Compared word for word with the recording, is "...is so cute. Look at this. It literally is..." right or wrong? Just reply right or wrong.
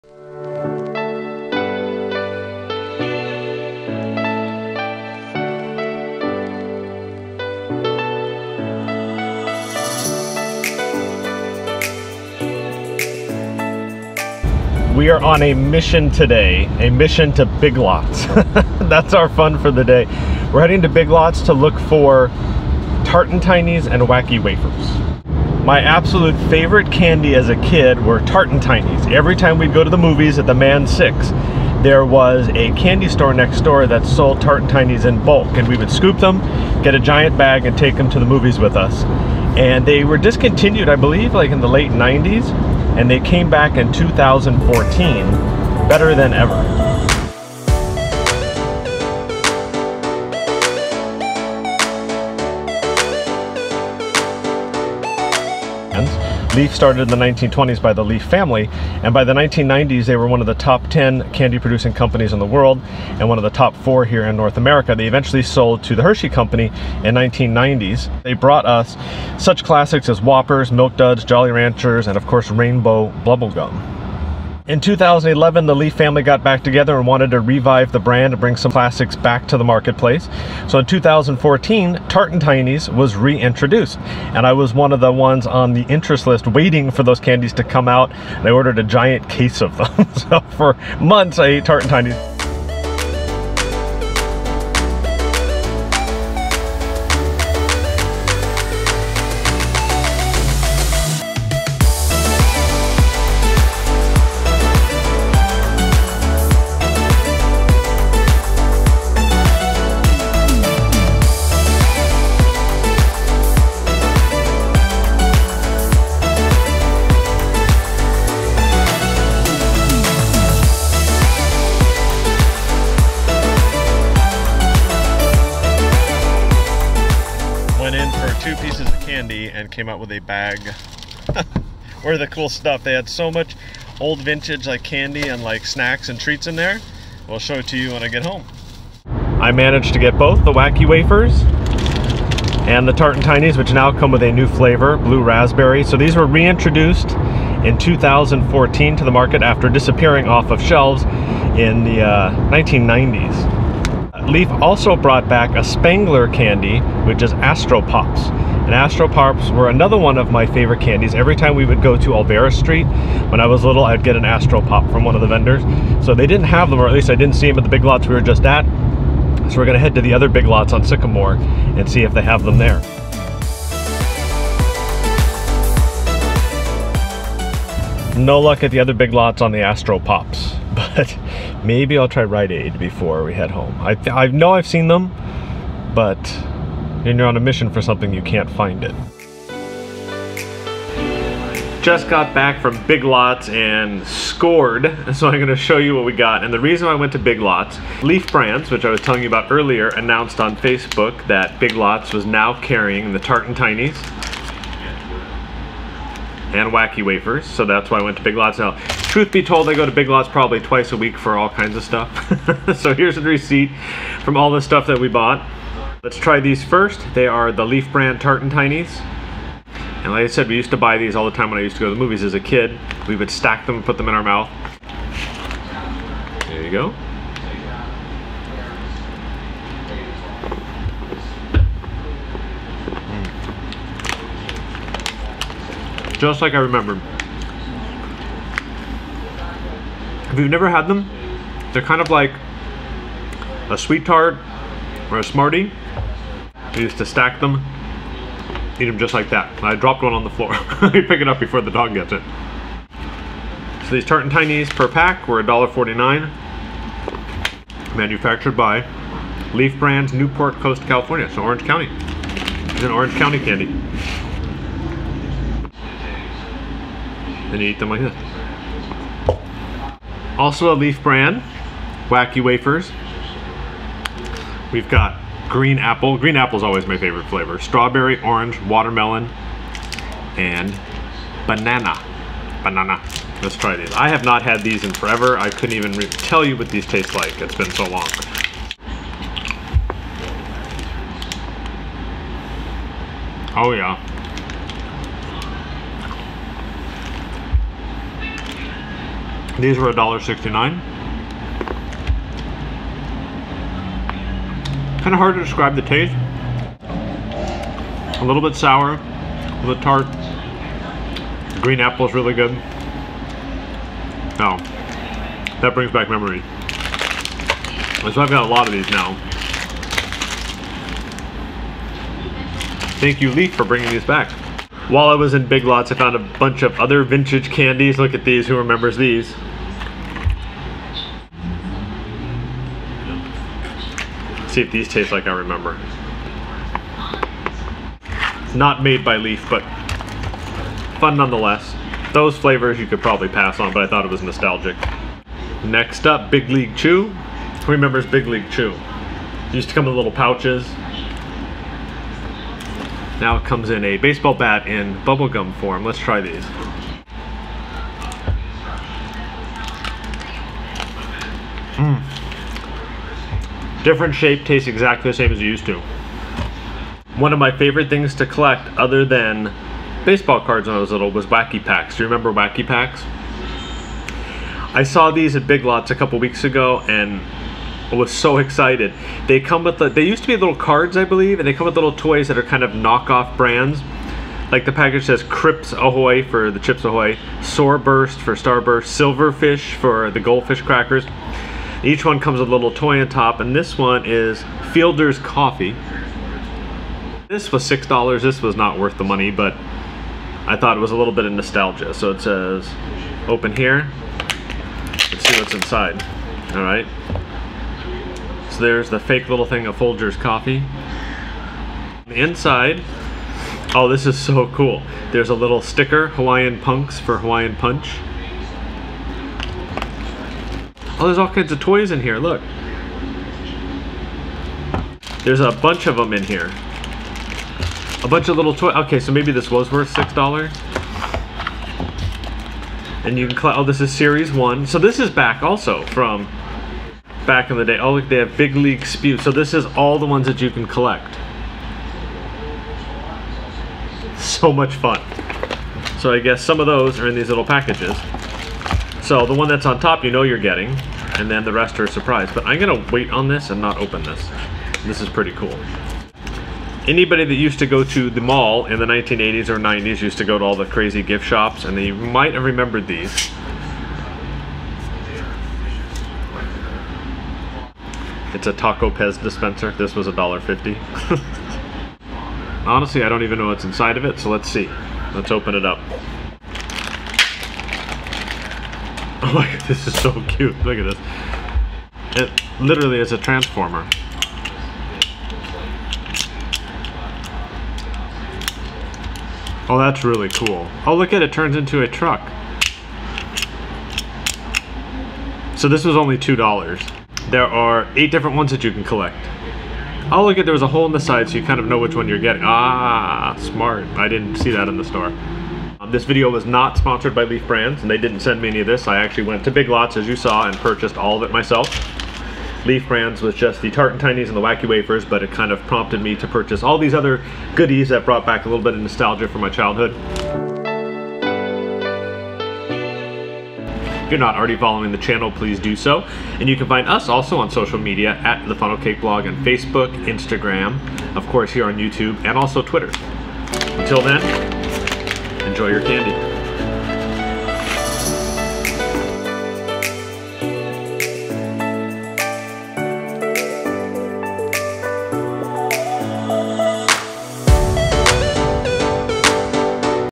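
right.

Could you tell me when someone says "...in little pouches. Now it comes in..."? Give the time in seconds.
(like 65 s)
349 s.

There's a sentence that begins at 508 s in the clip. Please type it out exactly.
I actually went to Big Lots, as you saw, and purchased all of it myself.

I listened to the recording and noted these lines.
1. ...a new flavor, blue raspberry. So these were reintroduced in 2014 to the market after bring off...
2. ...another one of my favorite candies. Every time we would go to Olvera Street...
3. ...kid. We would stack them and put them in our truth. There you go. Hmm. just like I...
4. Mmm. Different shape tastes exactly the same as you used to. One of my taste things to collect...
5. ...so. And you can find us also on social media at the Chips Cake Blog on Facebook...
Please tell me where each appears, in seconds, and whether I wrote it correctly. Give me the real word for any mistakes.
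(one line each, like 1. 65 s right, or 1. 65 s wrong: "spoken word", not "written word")
1. 144 s wrong: "disappearing", not "bring"
2. 159 s right
3. 222 s wrong: "mouth", not "truth"
4. 361 s wrong: "favorite", not "taste"
5. 525 s wrong: "Funnel", not "Chips".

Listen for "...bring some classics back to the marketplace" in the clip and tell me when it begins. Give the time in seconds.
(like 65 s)
78 s.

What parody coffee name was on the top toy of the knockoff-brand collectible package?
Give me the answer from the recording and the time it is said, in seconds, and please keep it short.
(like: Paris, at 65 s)
Fielder's Coffee, at 394 s.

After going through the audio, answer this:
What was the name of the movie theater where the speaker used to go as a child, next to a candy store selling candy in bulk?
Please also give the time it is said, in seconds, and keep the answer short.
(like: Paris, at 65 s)
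Mann 6, at 30 s.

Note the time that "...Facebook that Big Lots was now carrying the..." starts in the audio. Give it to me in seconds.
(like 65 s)
200 s.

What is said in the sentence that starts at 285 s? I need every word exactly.
I couldn't even tell you what these taste like.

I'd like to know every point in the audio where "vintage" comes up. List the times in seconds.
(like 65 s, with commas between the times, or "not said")
134 s, 327 s.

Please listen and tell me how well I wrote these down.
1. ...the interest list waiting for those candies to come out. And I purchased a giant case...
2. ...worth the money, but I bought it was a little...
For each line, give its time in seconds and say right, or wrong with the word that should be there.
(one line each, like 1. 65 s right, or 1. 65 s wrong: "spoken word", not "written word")
1. 85 s wrong: "ordered", not "purchased"
2. 398 s wrong: "thought", not "bought".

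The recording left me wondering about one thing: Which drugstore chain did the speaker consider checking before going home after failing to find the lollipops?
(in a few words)
Rite Aid.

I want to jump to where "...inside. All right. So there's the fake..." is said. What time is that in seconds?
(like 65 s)
405 s.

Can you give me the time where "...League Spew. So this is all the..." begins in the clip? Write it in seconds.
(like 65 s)
438 s.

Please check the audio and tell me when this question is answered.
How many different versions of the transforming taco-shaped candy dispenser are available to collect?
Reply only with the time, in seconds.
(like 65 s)
497 s.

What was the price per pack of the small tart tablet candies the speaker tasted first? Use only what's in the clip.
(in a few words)
$1.49.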